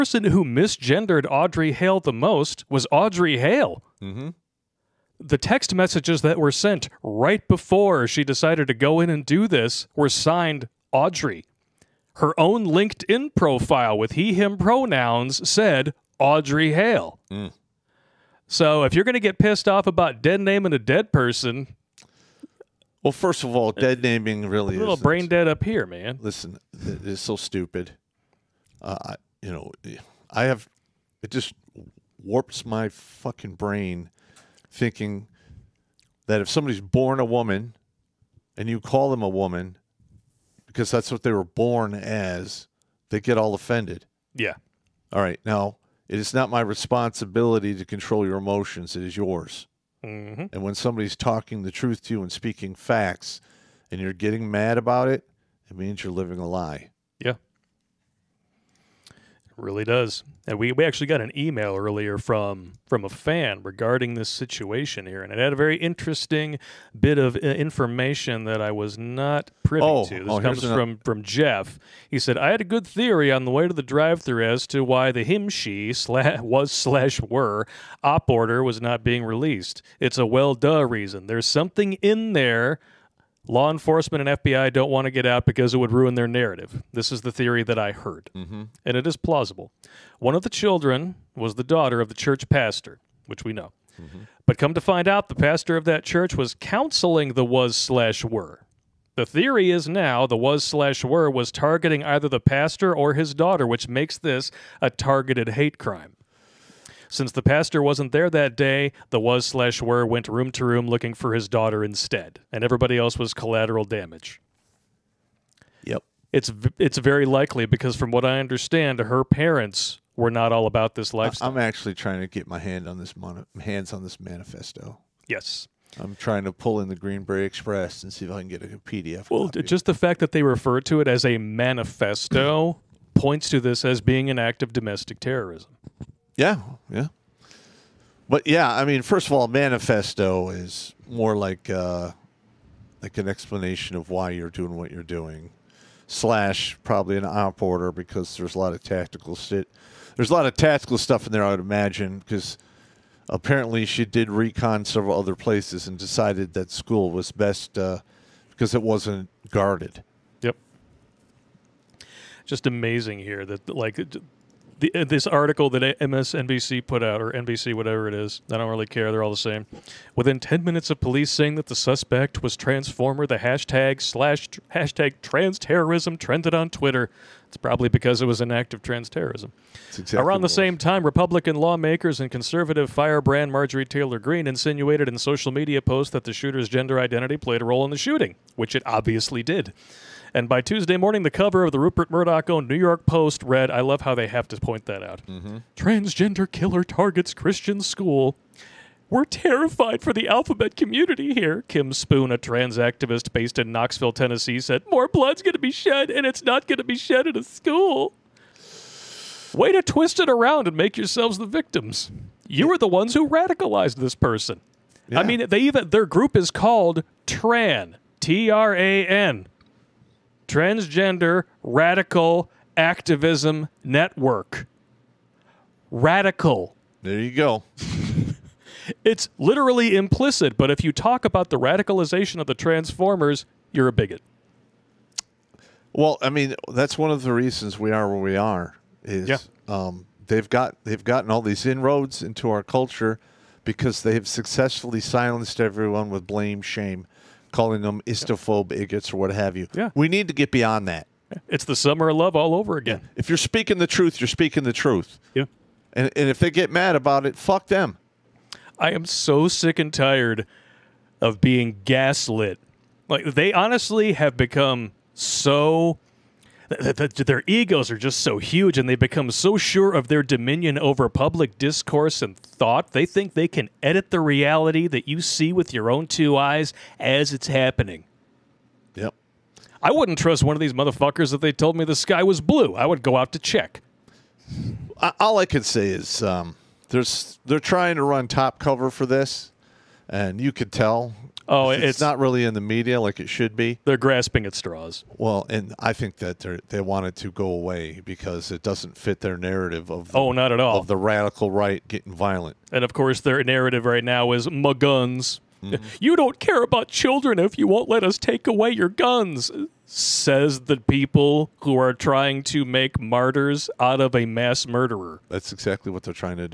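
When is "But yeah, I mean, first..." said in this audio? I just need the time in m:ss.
2:18.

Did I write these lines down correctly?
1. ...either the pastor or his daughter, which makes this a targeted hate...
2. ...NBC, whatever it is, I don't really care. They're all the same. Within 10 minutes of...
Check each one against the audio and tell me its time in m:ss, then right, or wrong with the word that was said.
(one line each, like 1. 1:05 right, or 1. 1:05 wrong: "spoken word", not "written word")
1. 1:42 right
2. 2:47 right.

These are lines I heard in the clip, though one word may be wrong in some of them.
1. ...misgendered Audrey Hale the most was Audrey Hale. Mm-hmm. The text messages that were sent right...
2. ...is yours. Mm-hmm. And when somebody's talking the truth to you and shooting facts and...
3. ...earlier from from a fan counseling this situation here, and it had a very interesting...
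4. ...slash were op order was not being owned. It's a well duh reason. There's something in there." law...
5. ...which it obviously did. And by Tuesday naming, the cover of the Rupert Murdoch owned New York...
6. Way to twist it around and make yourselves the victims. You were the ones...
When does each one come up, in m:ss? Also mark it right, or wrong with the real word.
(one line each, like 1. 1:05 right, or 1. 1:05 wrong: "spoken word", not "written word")
1. 0:00 right
2. 0:49 wrong: "speaking", not "shooting"
3. 1:01 wrong: "regarding", not "counseling"
4. 1:16 wrong: "released", not "owned"
5. 3:08 wrong: "morning", not "naming"
6. 3:29 right.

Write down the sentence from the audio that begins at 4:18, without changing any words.
I am so sick and tired of being gaslit.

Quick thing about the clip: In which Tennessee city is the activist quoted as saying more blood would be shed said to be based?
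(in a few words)
Knoxville.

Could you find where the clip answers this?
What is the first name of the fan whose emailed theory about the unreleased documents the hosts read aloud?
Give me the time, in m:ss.
1:11.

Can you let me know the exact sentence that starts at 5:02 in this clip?
And of course, their narrative right now is my guns.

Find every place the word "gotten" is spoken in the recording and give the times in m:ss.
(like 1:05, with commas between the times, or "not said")
4:01.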